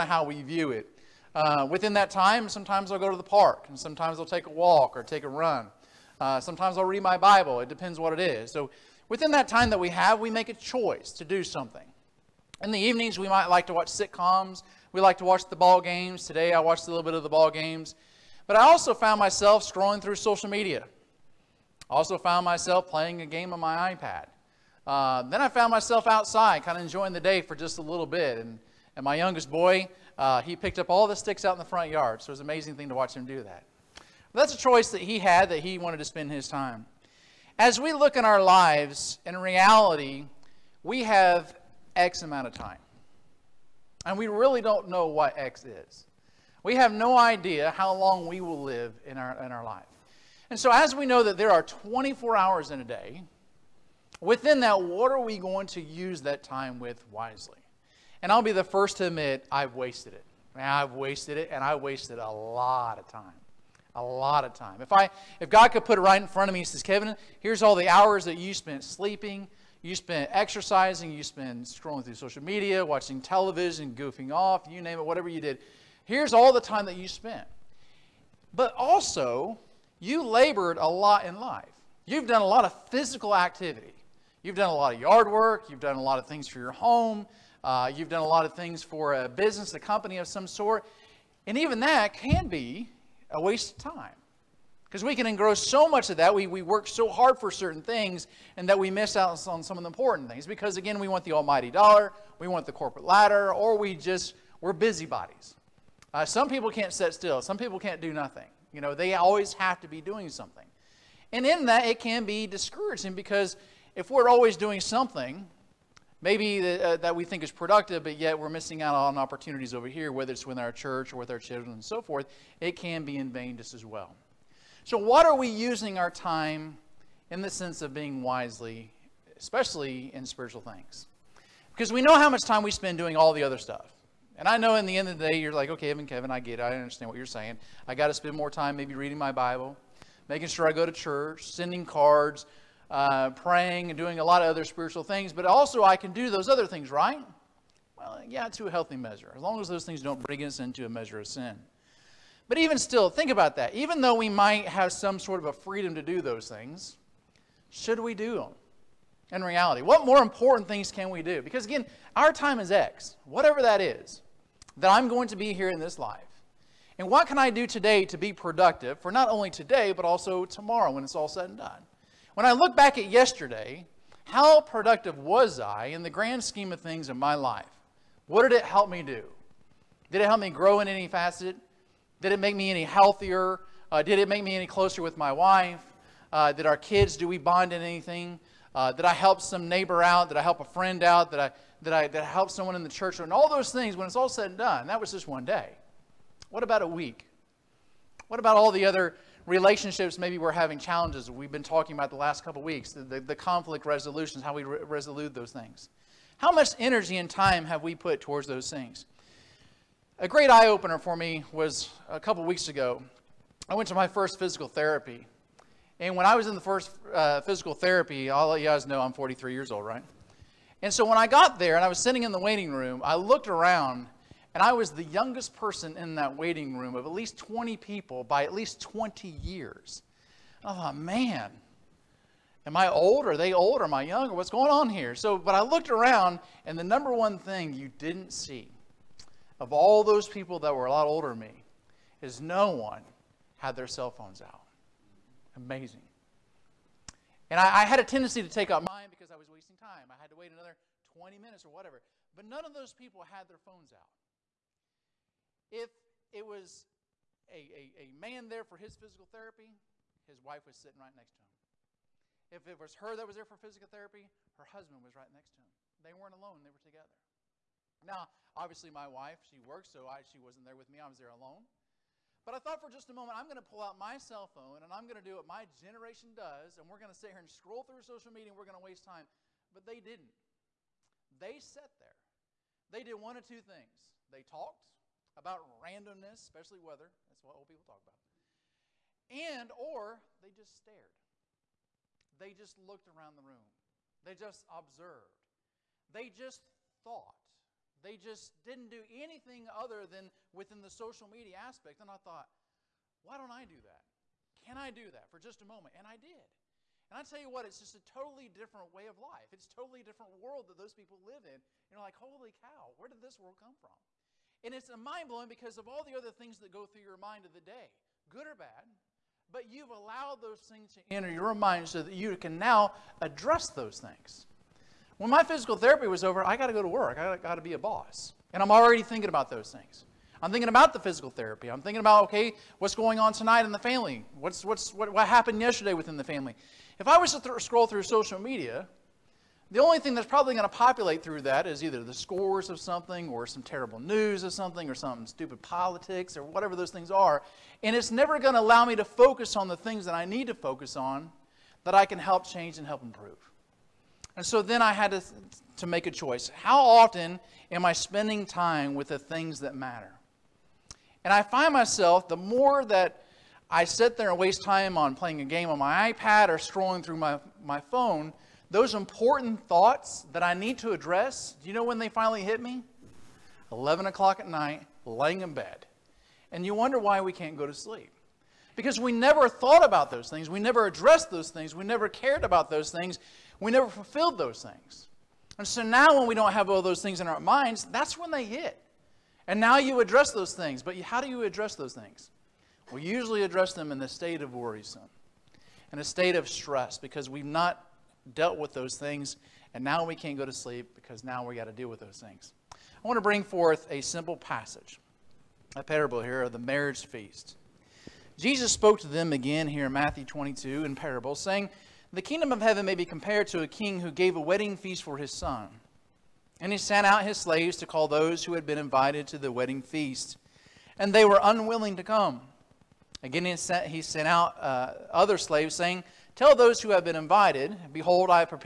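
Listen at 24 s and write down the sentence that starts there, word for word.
Uh, then I found myself outside, kind of enjoying the day for just a little bit.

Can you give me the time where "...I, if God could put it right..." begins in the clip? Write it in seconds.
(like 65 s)
64 s.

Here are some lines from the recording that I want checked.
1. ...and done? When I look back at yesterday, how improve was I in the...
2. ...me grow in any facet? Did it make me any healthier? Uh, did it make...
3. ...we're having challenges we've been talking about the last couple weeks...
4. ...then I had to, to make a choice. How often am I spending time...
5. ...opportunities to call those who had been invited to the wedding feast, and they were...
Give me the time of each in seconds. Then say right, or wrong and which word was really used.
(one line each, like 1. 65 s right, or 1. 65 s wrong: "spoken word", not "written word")
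1. 171 s wrong: "productive", not "improve"
2. 180 s right
3. 200 s right
4. 354 s right
5. 417 s wrong: "slaves", not "opportunities".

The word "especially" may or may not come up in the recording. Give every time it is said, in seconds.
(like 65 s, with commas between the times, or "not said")
129 s, 286 s.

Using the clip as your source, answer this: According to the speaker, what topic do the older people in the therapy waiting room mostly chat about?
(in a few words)
weather.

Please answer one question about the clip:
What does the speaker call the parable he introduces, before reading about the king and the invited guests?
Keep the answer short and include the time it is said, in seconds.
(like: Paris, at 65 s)
marriage feast, at 406 s.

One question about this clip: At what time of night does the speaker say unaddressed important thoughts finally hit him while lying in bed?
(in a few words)
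11 o'clock.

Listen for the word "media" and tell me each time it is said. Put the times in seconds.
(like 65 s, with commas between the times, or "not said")
20 s, 72 s, 278 s, 301 s, 338 s.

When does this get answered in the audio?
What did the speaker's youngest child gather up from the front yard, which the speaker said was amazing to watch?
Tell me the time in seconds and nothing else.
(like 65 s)
31 s.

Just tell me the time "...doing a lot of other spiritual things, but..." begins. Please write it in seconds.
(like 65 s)
143 s.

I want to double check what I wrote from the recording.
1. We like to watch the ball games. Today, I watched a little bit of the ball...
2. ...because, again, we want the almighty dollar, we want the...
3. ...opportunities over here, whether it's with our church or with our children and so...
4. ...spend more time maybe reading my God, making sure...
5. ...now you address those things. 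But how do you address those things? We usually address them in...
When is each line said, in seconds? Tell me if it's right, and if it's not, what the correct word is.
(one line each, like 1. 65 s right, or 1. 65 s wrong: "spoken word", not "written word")
1. 14 s right
2. 100 s right
3. 119 s right
4. 138 s wrong: "Bible", not "God"
5. 389 s right.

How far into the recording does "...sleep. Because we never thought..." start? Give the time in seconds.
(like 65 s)
377 s.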